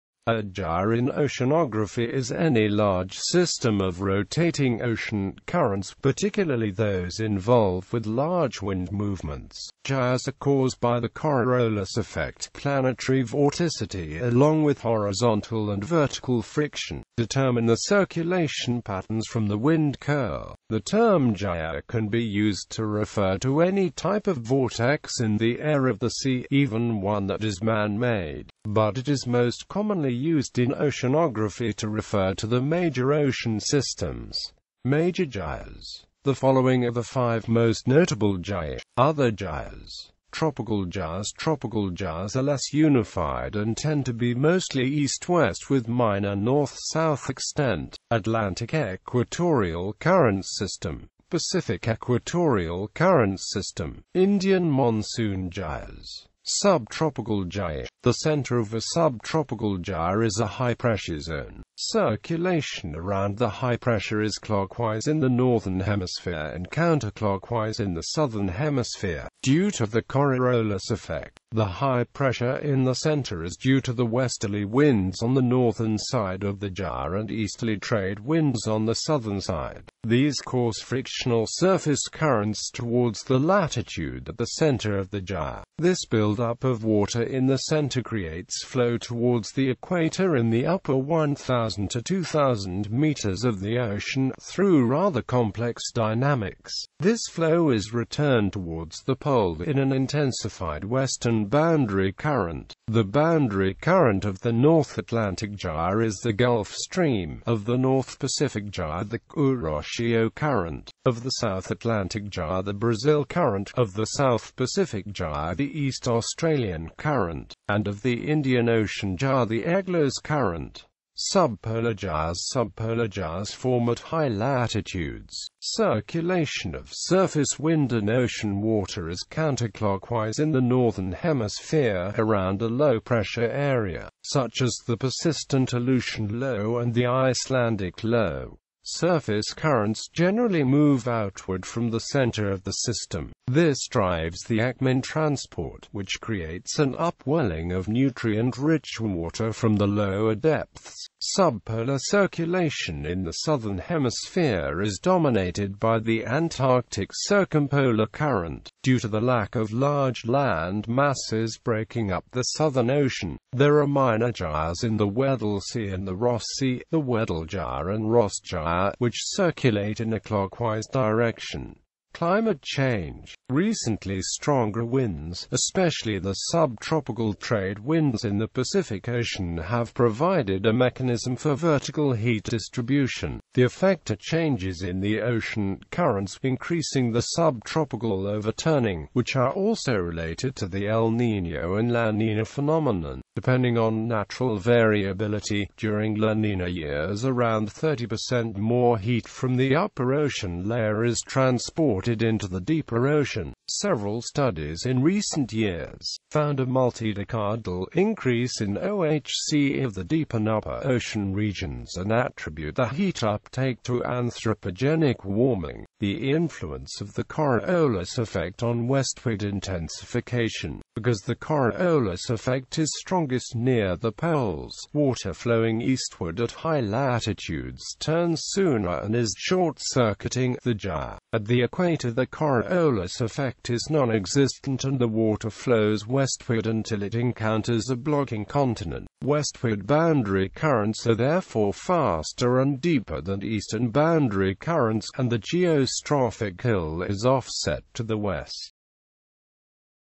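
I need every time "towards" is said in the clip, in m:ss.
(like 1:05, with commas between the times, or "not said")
1:22, 1:28, 1:38.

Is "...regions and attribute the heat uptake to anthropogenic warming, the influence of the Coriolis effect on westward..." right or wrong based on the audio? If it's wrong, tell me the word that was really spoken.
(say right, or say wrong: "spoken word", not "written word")
right.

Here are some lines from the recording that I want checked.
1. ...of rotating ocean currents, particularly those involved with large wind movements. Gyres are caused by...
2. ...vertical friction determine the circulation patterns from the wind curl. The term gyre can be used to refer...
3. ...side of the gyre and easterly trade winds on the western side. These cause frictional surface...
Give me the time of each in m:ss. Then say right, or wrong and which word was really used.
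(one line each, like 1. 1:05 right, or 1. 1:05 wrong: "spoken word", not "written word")
1. 0:03 right
2. 0:15 right
3. 1:15 wrong: "southern", not "western".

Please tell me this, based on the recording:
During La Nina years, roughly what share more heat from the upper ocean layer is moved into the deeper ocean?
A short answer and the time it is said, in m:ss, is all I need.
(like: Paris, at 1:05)
30%, at 3:17.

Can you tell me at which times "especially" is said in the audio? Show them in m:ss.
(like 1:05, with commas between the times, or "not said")
2:55.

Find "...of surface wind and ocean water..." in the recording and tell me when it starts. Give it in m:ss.
2:06.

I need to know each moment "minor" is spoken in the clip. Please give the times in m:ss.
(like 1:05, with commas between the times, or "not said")
0:45, 2:43.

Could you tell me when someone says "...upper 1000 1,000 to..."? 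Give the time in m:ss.
1:30.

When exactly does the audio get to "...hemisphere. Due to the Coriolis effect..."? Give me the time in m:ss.
1:08.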